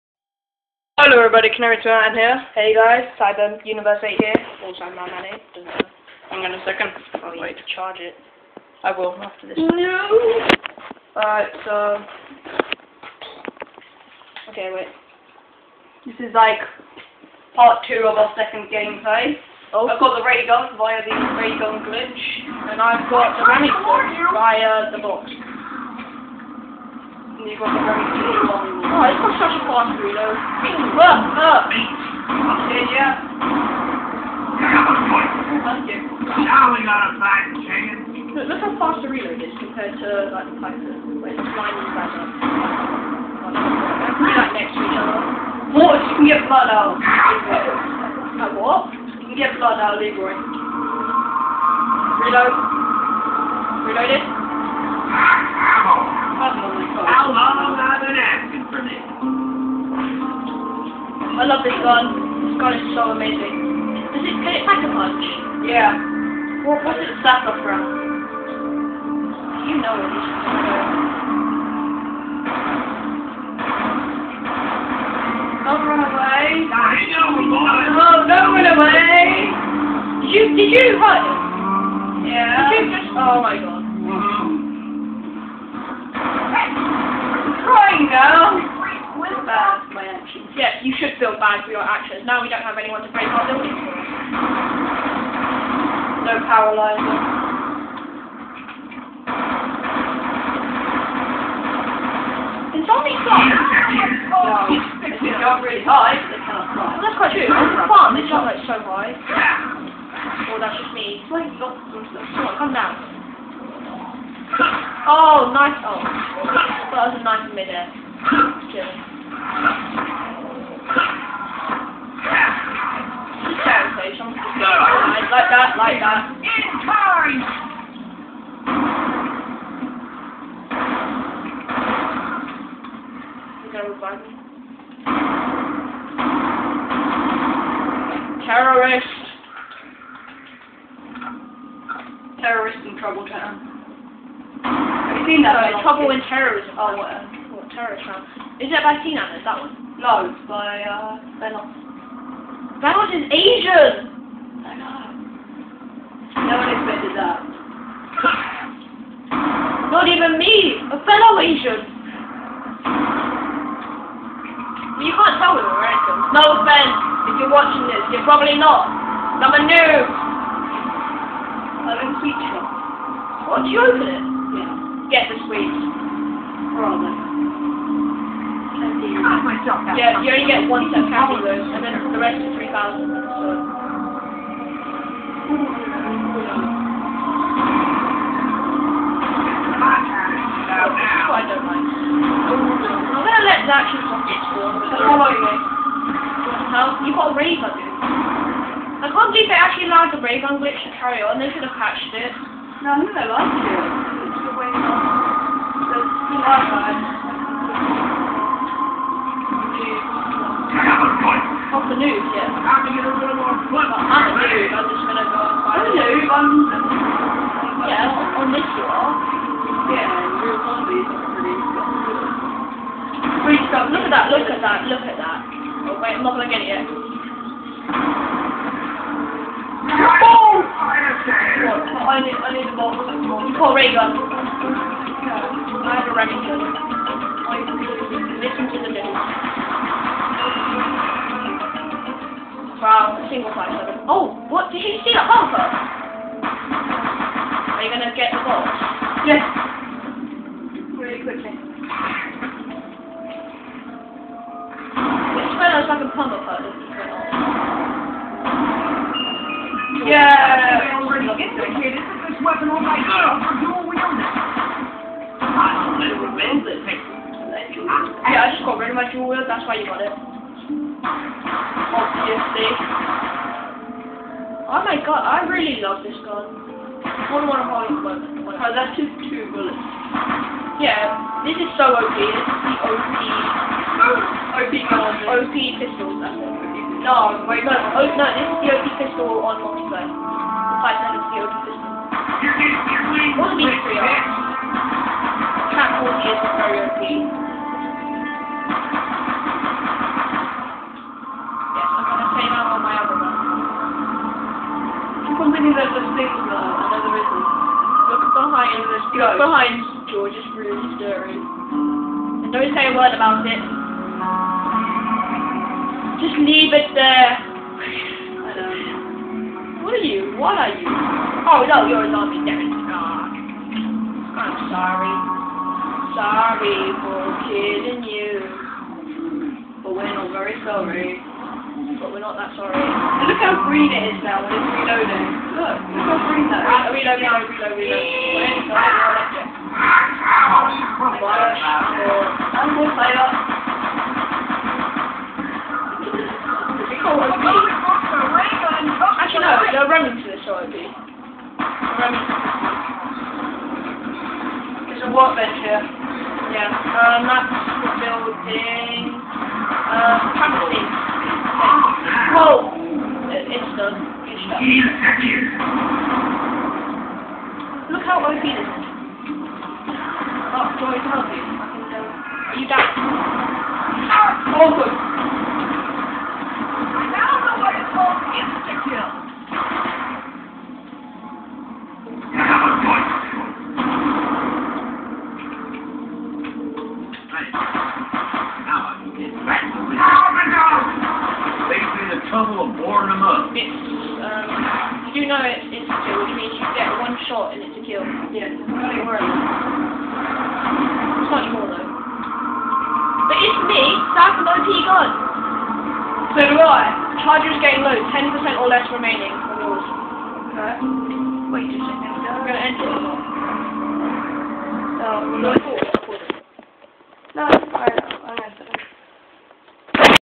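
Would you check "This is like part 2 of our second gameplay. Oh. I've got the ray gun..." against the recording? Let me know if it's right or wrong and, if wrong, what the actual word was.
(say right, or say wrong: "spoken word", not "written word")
right.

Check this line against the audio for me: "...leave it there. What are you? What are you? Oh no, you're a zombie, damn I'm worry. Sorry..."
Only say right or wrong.
wrong.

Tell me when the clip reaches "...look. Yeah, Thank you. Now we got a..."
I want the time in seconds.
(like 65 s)
31 s.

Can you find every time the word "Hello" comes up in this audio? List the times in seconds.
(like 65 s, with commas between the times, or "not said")
1 s.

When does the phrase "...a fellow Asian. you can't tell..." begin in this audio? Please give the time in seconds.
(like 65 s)
160 s.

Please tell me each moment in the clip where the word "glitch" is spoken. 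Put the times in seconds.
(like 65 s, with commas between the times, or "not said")
21 s, 200 s.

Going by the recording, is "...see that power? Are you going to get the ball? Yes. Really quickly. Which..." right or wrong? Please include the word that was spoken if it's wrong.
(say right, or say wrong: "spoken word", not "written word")
wrong: "bumper", not "power".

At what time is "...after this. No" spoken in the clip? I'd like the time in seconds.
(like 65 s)
9 s.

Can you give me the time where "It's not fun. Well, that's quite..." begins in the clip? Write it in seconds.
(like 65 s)
106 s.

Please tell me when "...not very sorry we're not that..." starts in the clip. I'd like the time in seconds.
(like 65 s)
330 s.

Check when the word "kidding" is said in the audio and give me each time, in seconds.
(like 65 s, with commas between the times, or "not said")
327 s.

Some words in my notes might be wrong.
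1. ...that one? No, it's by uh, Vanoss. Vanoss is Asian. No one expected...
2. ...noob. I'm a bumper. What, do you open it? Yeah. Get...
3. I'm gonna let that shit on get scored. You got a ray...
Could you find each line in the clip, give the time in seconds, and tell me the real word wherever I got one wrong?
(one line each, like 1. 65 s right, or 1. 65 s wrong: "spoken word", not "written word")
1. 149 s right
2. 169 s wrong: "teacher", not "bumper"
3. 192 s right.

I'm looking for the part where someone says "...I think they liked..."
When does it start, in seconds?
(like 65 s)
202 s.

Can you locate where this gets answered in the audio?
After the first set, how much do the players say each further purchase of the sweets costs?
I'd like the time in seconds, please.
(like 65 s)
182 s.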